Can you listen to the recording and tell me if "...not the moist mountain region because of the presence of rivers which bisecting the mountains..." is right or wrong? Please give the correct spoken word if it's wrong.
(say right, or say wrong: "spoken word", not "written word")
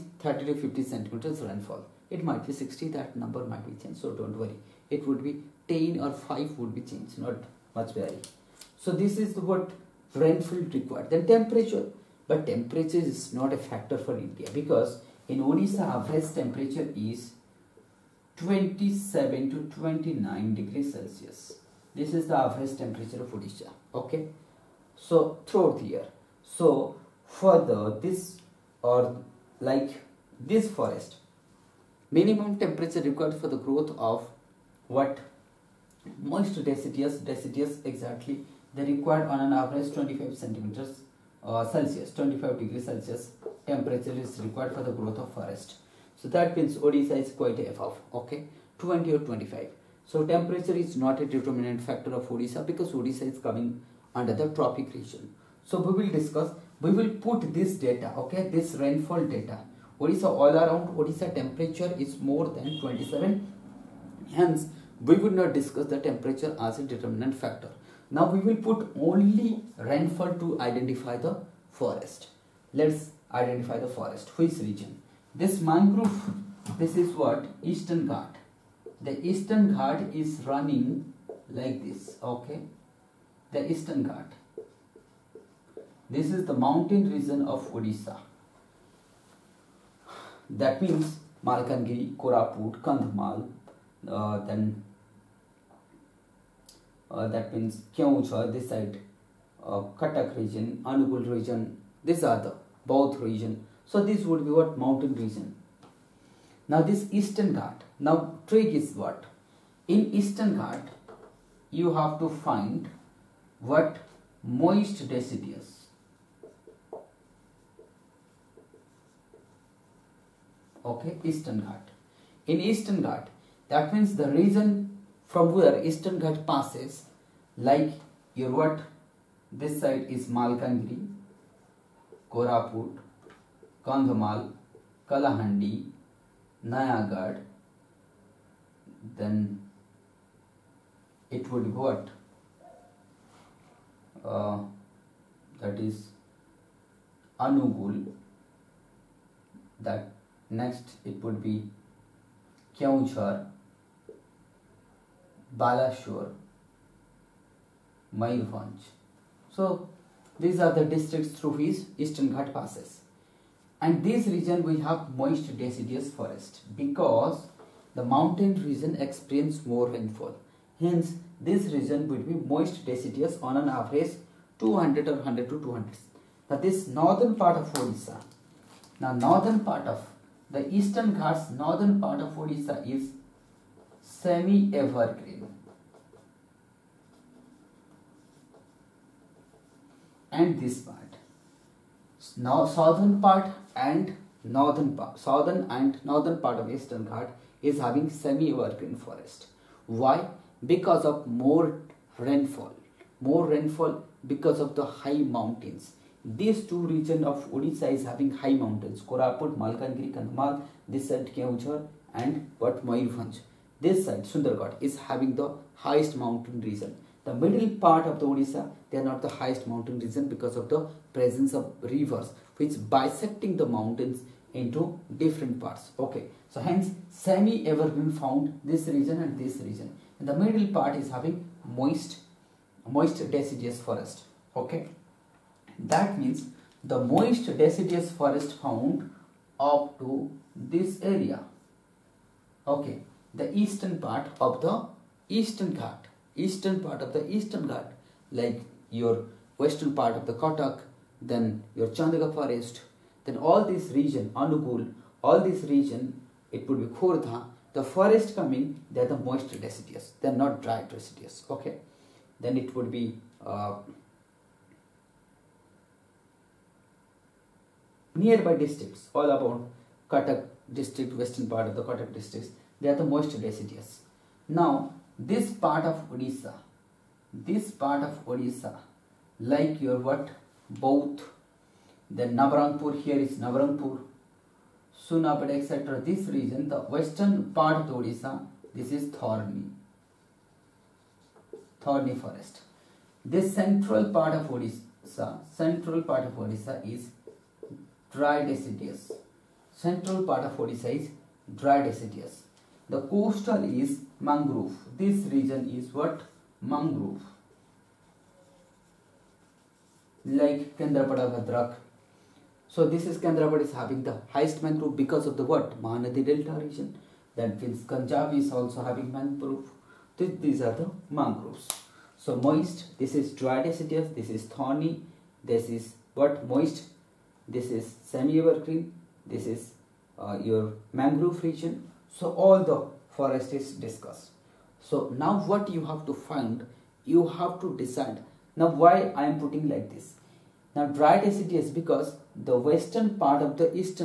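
wrong: "highest", not "moist".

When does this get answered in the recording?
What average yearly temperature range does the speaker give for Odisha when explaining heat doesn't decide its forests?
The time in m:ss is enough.
0:18.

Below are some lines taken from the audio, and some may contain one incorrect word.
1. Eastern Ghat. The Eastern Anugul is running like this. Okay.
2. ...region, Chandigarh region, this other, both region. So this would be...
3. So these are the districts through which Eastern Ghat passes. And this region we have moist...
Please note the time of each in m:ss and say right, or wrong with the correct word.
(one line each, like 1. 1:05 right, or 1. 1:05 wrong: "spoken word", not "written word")
1. 1:17 wrong: "Ghat", not "Anugul"
2. 1:40 wrong: "Anugul", not "Chandigarh"
3. 2:39 right.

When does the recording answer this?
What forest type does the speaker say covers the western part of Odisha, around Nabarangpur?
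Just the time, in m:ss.
4:51.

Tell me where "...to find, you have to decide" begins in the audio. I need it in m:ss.
5:36.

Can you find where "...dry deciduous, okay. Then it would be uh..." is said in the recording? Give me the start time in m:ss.
4:20.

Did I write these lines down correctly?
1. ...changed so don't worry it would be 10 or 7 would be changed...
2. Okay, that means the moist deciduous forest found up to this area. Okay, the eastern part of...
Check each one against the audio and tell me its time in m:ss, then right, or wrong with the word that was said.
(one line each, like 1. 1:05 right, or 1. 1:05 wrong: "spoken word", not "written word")
1. 0:03 wrong: "5", not "7"
2. 3:54 right.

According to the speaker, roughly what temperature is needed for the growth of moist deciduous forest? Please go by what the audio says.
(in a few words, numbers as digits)
25 degrees Celsius.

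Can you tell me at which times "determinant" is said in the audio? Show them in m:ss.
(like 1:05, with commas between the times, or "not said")
0:51, 1:06.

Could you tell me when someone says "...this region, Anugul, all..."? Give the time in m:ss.
4:13.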